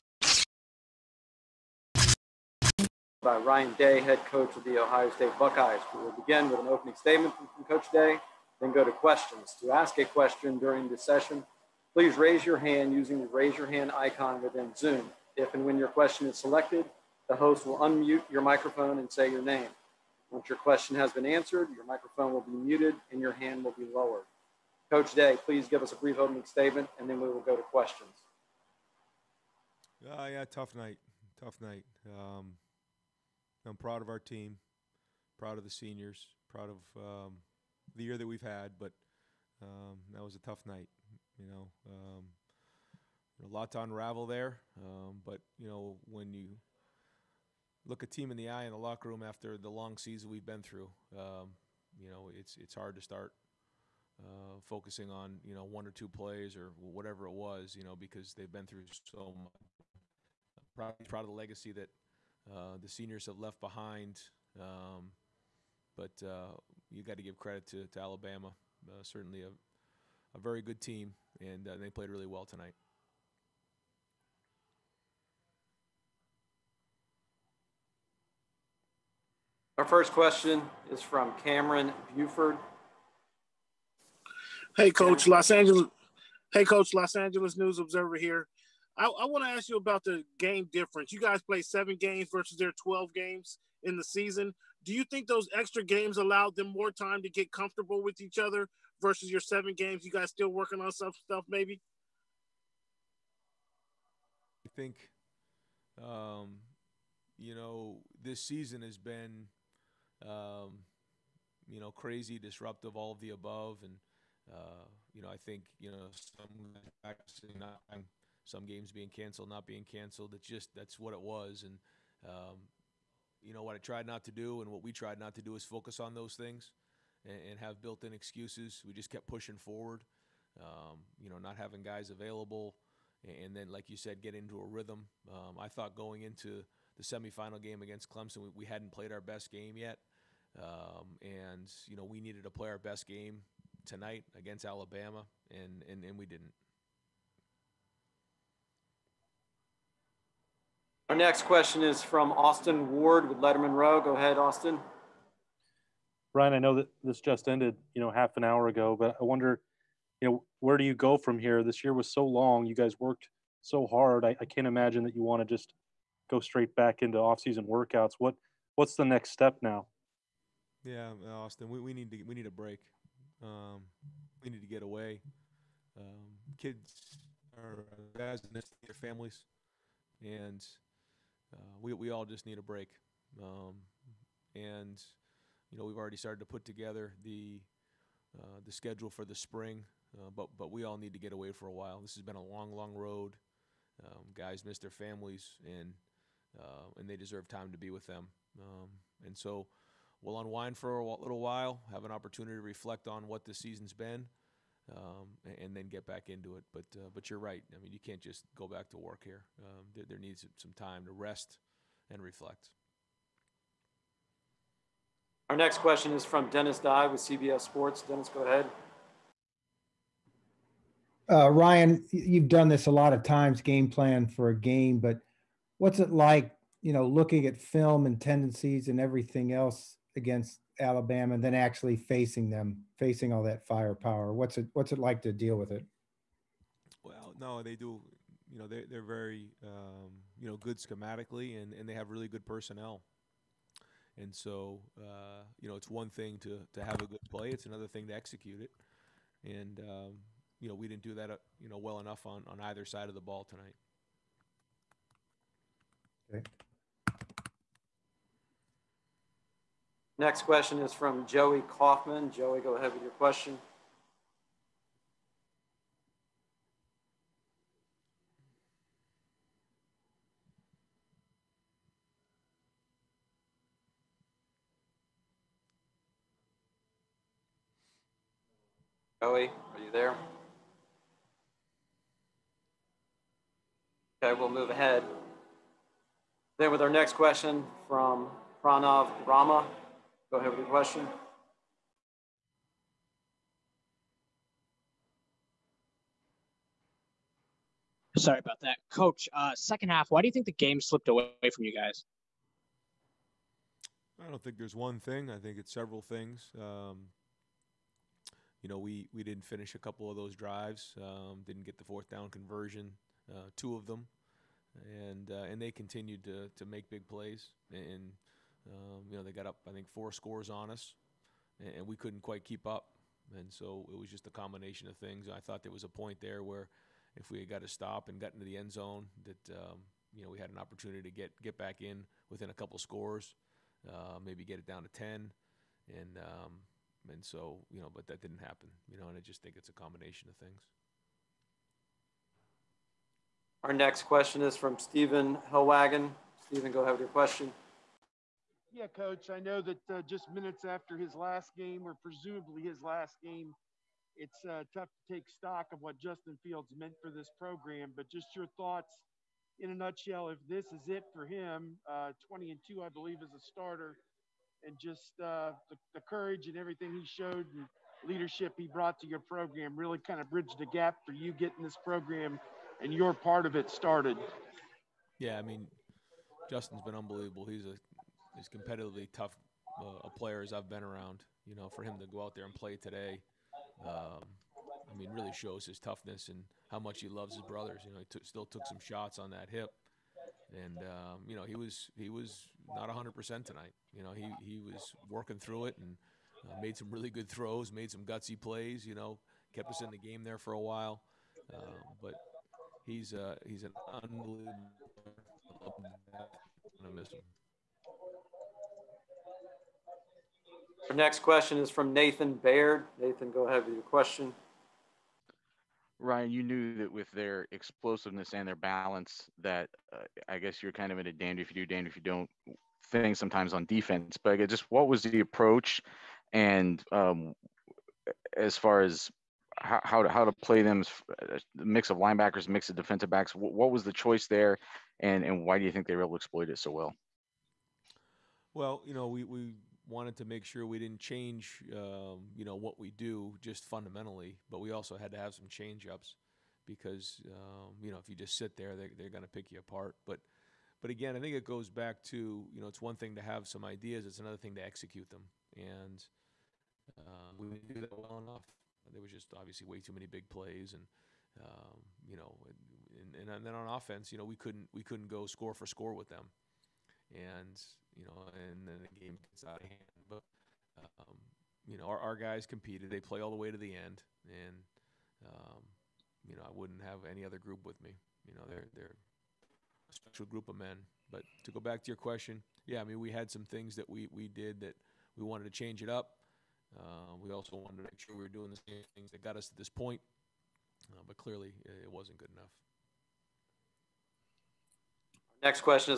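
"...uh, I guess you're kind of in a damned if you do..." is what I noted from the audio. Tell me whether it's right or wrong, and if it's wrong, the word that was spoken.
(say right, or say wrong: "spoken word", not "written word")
right.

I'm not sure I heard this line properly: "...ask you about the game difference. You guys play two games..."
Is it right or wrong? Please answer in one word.
wrong.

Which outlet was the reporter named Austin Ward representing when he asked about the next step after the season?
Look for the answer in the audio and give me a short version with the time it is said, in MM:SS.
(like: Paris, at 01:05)
Letterman Row, at 02:33.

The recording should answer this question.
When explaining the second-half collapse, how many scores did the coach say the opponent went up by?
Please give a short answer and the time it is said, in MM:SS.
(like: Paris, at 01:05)
4, at 05:19.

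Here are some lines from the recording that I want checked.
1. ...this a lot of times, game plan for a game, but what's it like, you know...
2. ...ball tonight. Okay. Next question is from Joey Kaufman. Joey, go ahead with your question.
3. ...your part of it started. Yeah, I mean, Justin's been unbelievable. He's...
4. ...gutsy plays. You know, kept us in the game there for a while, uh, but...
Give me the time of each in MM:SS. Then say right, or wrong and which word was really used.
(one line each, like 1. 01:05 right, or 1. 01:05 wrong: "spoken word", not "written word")
1. 03:42 right
2. 04:13 right
3. 06:12 right
4. 06:38 right.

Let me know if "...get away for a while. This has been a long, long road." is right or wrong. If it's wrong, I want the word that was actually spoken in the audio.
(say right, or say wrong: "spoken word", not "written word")
right.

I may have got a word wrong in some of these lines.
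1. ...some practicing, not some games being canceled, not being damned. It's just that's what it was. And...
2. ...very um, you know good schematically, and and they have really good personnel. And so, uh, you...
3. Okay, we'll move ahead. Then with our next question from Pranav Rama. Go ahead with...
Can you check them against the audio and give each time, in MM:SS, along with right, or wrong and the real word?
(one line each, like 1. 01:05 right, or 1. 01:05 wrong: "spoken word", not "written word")
1. 01:56 wrong: "canceled", not "damned"
2. 03:59 right
3. 04:44 right.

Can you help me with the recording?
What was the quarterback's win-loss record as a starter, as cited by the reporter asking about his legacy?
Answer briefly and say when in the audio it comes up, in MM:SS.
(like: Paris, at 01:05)
20-2, at 06:02.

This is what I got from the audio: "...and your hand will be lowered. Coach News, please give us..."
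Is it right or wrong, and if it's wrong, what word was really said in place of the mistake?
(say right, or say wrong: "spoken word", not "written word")
wrong: "Day", not "News".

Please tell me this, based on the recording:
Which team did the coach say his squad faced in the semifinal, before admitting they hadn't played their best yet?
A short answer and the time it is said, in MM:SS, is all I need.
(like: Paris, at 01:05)
Clemson, at 02:18.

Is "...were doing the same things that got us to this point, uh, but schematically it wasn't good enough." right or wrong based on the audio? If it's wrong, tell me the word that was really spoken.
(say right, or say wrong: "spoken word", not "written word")
wrong: "clearly", not "schematically".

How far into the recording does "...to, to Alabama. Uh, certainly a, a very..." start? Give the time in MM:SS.
01:07.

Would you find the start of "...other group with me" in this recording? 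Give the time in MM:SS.
07:57.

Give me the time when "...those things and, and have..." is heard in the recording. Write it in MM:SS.
02:06.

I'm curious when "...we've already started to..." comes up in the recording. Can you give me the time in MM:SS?
03:05.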